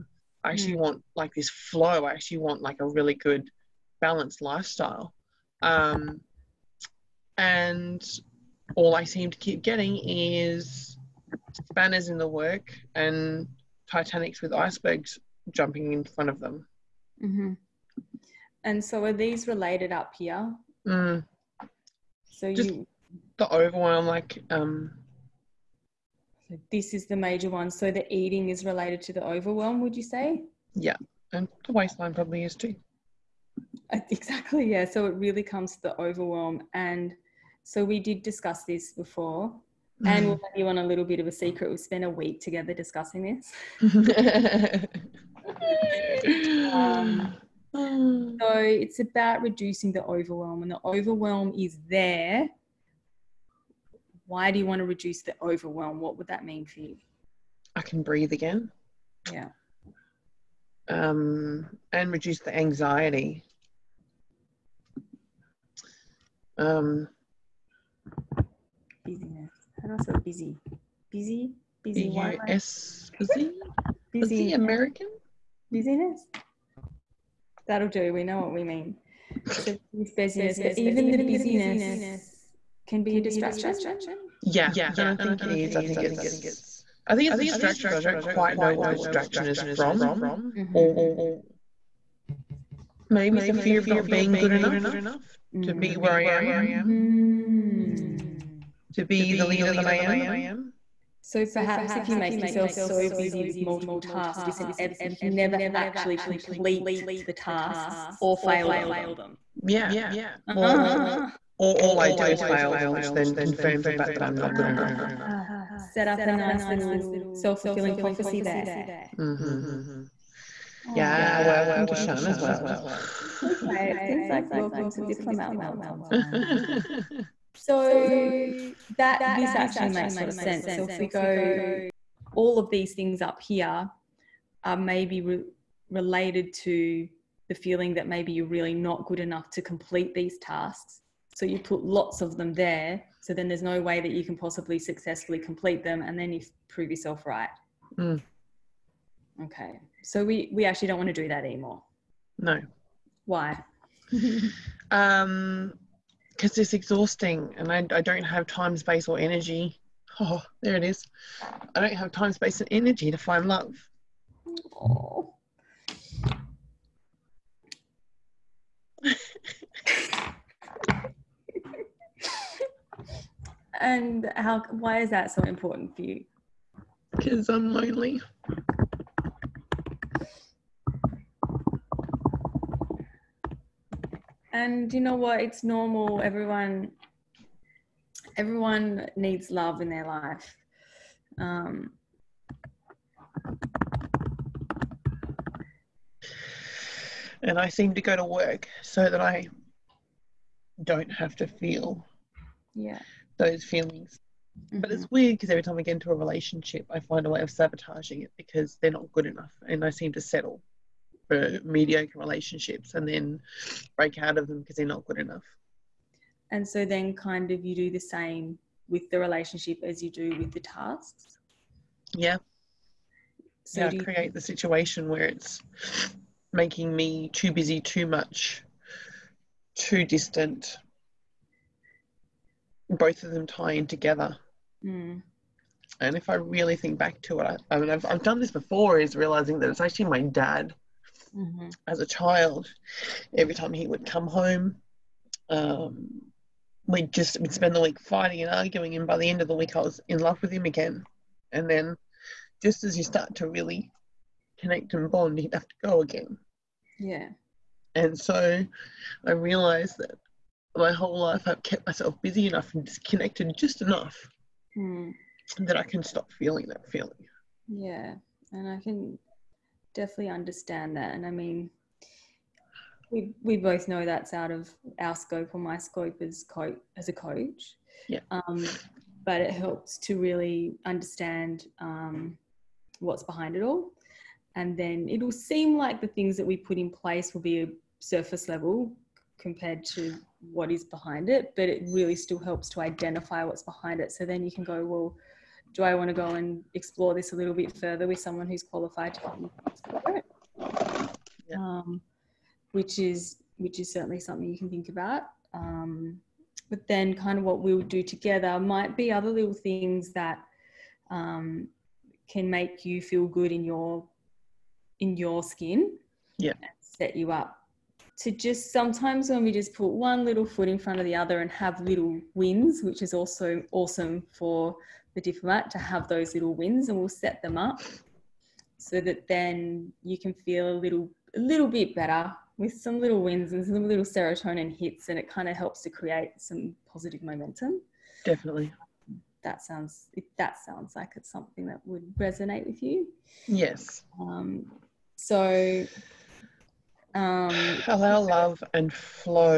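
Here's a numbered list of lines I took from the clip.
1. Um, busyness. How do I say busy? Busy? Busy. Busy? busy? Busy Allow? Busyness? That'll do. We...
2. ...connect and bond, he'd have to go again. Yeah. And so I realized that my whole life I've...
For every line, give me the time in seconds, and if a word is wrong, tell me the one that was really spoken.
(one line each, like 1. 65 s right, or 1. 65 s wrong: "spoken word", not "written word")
1. 66 s wrong: "American", not "Allow"
2. 254 s right.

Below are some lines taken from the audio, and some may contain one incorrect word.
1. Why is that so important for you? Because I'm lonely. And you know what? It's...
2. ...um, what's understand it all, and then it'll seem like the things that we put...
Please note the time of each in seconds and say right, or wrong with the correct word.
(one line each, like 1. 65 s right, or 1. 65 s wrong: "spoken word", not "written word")
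1. 174 s right
2. 281 s wrong: "behind", not "understand".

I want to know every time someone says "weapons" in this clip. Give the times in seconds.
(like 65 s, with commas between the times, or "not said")
not said.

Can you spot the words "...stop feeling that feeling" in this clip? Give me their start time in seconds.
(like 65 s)
266 s.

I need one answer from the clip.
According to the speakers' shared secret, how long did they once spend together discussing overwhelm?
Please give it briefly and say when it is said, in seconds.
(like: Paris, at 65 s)
a week, at 42 s.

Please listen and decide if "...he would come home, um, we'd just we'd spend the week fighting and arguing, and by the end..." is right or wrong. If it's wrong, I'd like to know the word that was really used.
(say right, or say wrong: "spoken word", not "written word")
right.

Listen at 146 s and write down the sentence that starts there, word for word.
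And then you prove yourself right.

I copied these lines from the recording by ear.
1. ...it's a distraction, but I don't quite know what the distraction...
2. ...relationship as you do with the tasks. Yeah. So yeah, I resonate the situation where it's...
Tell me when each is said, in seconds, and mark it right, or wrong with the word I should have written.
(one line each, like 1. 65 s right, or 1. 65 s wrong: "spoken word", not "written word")
1. 87 s right
2. 219 s wrong: "create", not "resonate".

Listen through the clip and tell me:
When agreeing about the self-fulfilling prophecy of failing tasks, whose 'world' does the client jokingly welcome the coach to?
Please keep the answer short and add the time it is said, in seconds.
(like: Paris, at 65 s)
Shana's world, at 121 s.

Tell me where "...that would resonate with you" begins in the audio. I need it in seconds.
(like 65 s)
341 s.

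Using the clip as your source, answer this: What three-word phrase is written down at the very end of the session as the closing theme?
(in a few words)
Allow love and flow.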